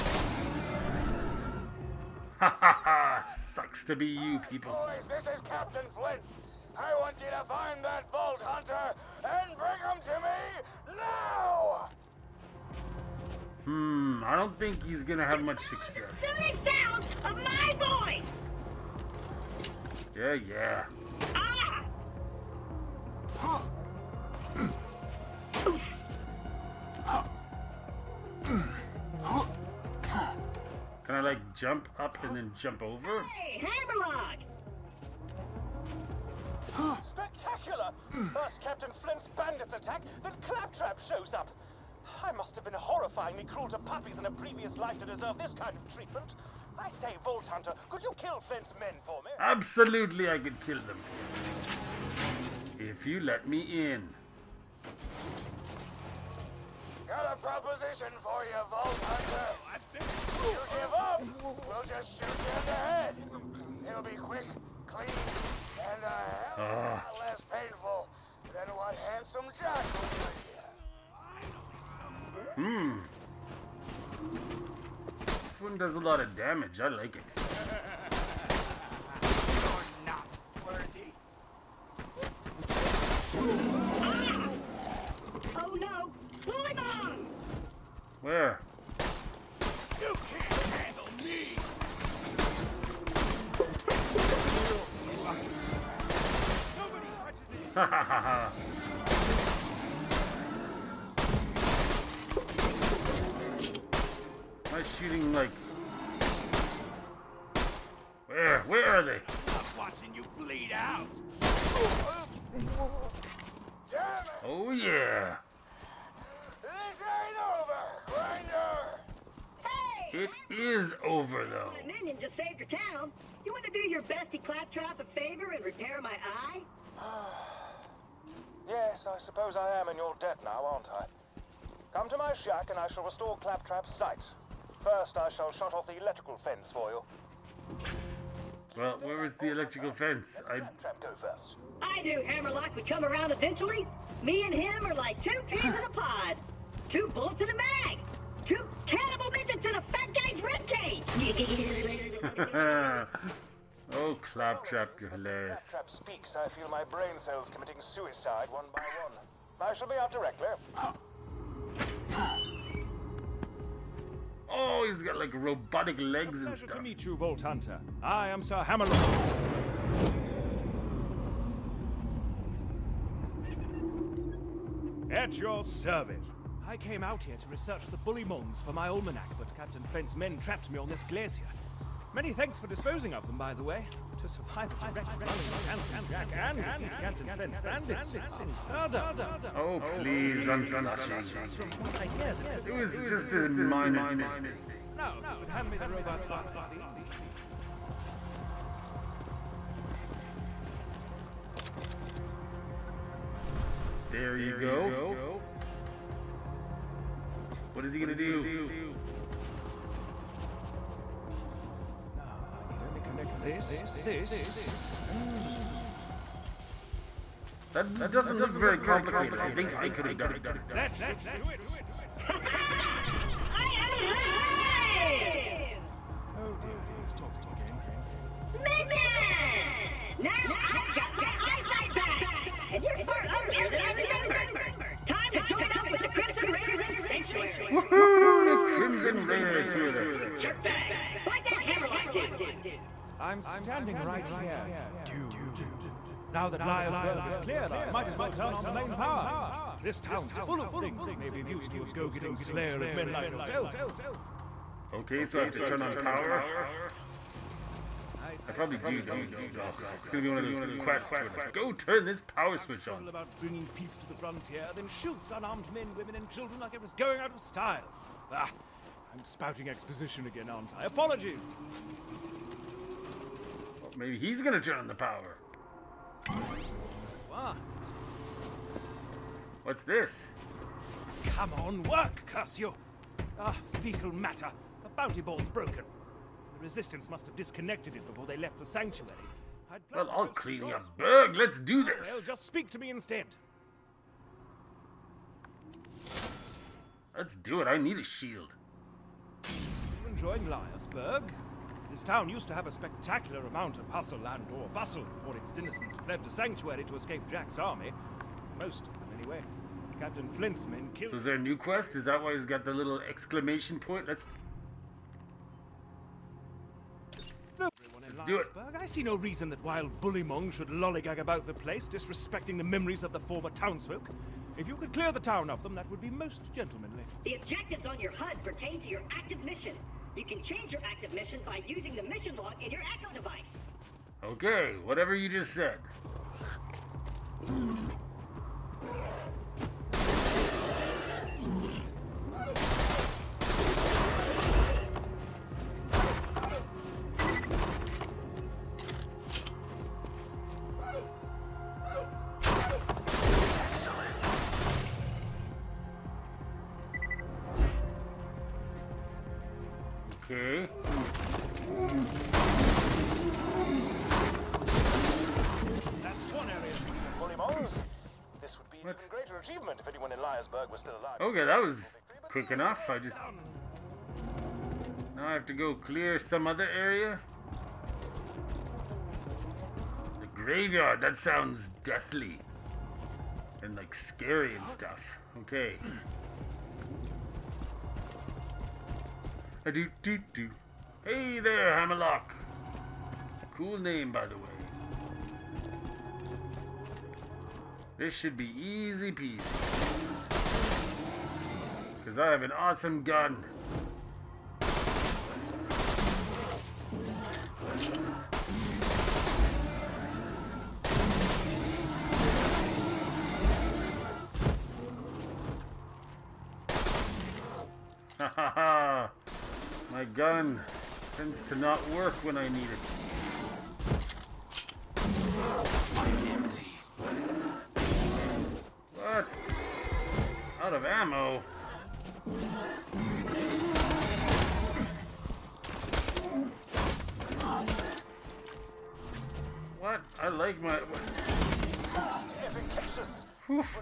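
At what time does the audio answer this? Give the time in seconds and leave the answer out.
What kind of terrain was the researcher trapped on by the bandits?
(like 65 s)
181 s.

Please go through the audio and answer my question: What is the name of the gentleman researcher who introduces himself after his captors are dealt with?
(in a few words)
Sir Hammerlock.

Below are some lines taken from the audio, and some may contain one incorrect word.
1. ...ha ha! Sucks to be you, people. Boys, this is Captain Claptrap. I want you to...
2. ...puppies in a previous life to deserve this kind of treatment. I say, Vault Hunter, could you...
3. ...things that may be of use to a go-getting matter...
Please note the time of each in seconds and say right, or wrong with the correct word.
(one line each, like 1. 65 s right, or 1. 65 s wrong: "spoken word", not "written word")
1. 2 s wrong: "Flint", not "Claptrap"
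2. 43 s right
3. 250 s wrong: "slayer", not "matter".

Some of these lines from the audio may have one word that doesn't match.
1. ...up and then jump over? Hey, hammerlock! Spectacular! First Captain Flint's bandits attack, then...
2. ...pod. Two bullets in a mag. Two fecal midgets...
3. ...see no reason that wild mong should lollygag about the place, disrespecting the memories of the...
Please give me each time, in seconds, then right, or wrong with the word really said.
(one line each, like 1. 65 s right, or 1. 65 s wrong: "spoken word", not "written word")
1. 31 s right
2. 145 s wrong: "cannibal", not "fecal"
3. 318 s right.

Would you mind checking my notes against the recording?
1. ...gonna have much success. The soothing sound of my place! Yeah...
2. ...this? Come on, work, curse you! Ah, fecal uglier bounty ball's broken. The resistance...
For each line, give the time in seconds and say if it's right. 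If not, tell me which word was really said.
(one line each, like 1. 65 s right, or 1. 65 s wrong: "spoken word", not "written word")
1. 15 s wrong: "voice", not "place"
2. 279 s wrong: "matter", not "uglier".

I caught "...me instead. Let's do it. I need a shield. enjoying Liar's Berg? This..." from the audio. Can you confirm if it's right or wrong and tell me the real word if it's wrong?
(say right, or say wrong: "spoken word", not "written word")
right.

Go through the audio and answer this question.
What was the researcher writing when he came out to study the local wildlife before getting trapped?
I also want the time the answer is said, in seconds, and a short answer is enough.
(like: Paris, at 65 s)
almanac, at 178 s.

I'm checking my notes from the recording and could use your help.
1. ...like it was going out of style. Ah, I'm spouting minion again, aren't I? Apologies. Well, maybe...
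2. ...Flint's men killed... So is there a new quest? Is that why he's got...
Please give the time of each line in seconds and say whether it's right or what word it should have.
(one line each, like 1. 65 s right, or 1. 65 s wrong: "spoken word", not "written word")
1. 266 s wrong: "exposition", not "minion"
2. 310 s right.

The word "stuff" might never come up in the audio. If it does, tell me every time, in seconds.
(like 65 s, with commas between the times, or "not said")
166 s, 384 s.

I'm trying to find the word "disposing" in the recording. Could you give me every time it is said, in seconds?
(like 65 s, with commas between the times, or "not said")
182 s.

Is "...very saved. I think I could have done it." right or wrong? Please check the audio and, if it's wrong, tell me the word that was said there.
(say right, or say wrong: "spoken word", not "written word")
wrong: "complicated", not "saved".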